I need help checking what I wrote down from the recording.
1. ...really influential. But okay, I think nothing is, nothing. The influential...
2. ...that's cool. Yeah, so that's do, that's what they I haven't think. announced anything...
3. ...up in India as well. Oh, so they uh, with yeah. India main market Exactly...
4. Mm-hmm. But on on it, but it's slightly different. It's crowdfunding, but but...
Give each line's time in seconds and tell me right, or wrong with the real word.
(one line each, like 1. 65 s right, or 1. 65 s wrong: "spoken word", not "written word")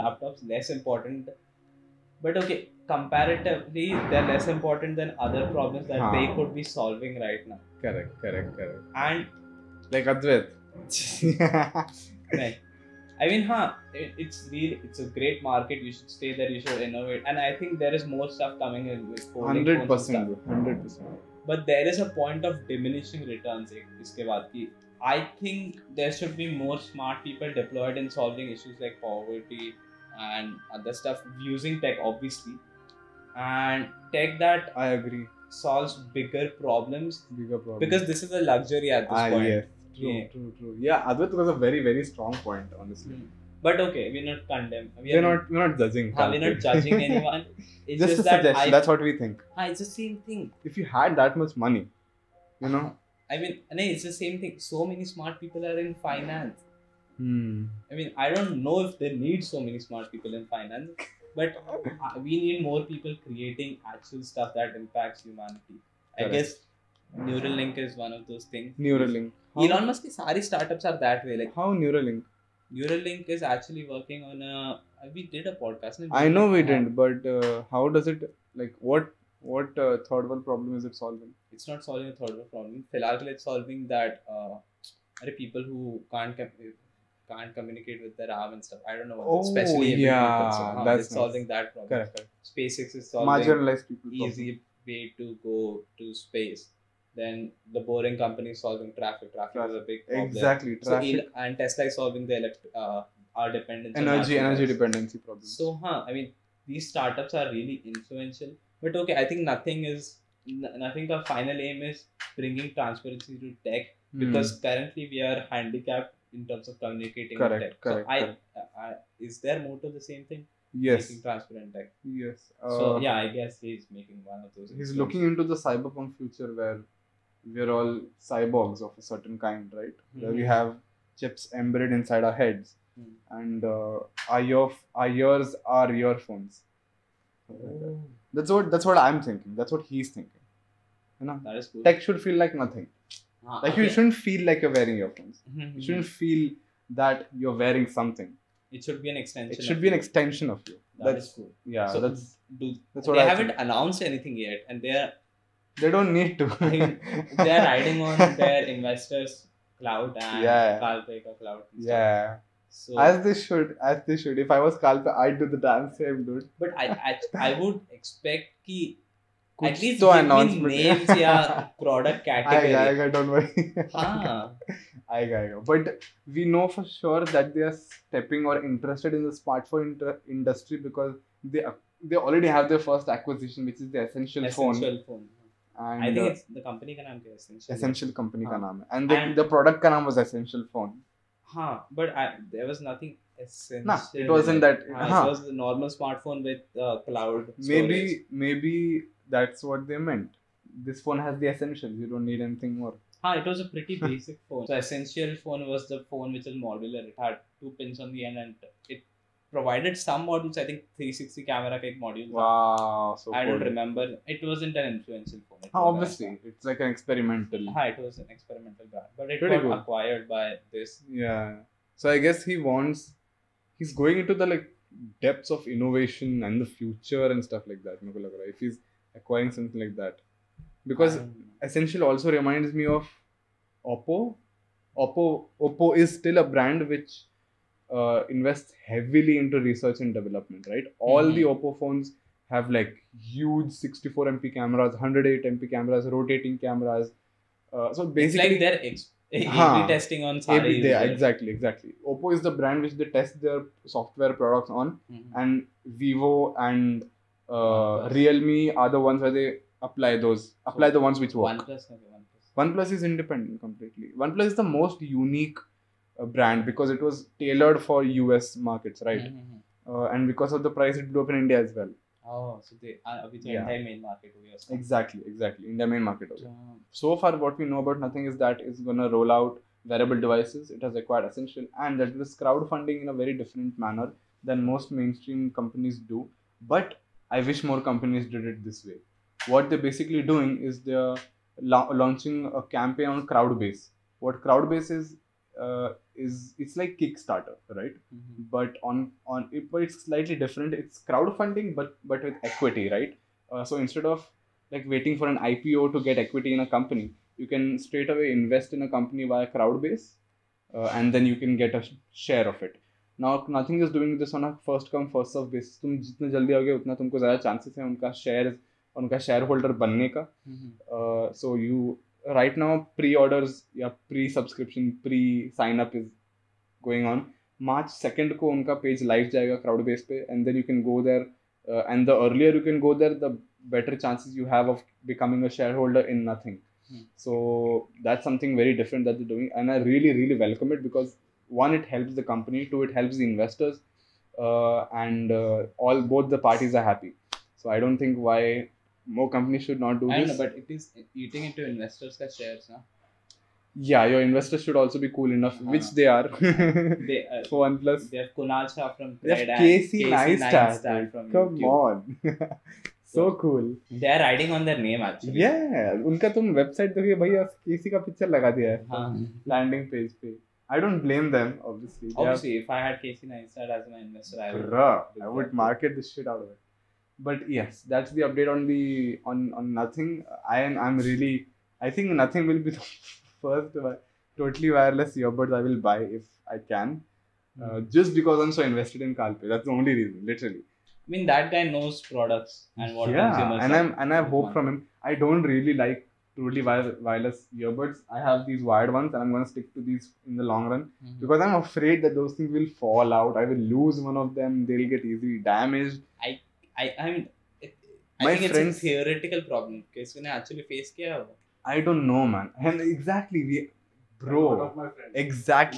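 1. 107 s wrong: "final", not "influential"
2. 151 s right
3. 271 s right
4. 298 s right.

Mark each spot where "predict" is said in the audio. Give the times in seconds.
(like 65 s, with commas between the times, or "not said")
not said.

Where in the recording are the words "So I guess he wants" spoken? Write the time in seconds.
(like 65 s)
222 s.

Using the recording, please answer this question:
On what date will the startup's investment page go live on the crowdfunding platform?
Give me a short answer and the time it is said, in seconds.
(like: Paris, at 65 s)
March 2, at 327 s.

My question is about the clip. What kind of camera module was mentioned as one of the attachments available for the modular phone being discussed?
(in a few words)
360 camera.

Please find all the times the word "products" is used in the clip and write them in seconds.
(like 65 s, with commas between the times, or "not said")
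171 s, 254 s, 392 s.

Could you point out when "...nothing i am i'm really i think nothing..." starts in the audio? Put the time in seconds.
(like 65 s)
379 s.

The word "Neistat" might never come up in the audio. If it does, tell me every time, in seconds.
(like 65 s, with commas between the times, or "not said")
360 s, 373 s.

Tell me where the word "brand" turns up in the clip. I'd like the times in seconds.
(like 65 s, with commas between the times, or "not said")
218 s, 236 s, 252 s, 266 s.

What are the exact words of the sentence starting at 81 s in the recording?
It's not solving a third world problem.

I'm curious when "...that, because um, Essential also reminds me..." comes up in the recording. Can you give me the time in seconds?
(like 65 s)
230 s.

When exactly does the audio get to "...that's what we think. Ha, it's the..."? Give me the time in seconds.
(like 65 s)
48 s.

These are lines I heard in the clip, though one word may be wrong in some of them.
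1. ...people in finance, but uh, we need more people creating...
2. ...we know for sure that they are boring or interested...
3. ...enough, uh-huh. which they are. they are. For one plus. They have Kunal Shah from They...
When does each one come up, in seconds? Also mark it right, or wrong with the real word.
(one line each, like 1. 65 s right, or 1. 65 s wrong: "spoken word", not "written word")
1. 60 s right
2. 176 s wrong: "stepping", not "boring"
3. 355 s right.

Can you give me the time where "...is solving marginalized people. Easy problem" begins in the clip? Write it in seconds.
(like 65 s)
92 s.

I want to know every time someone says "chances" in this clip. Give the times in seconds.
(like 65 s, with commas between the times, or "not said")
317 s, 334 s.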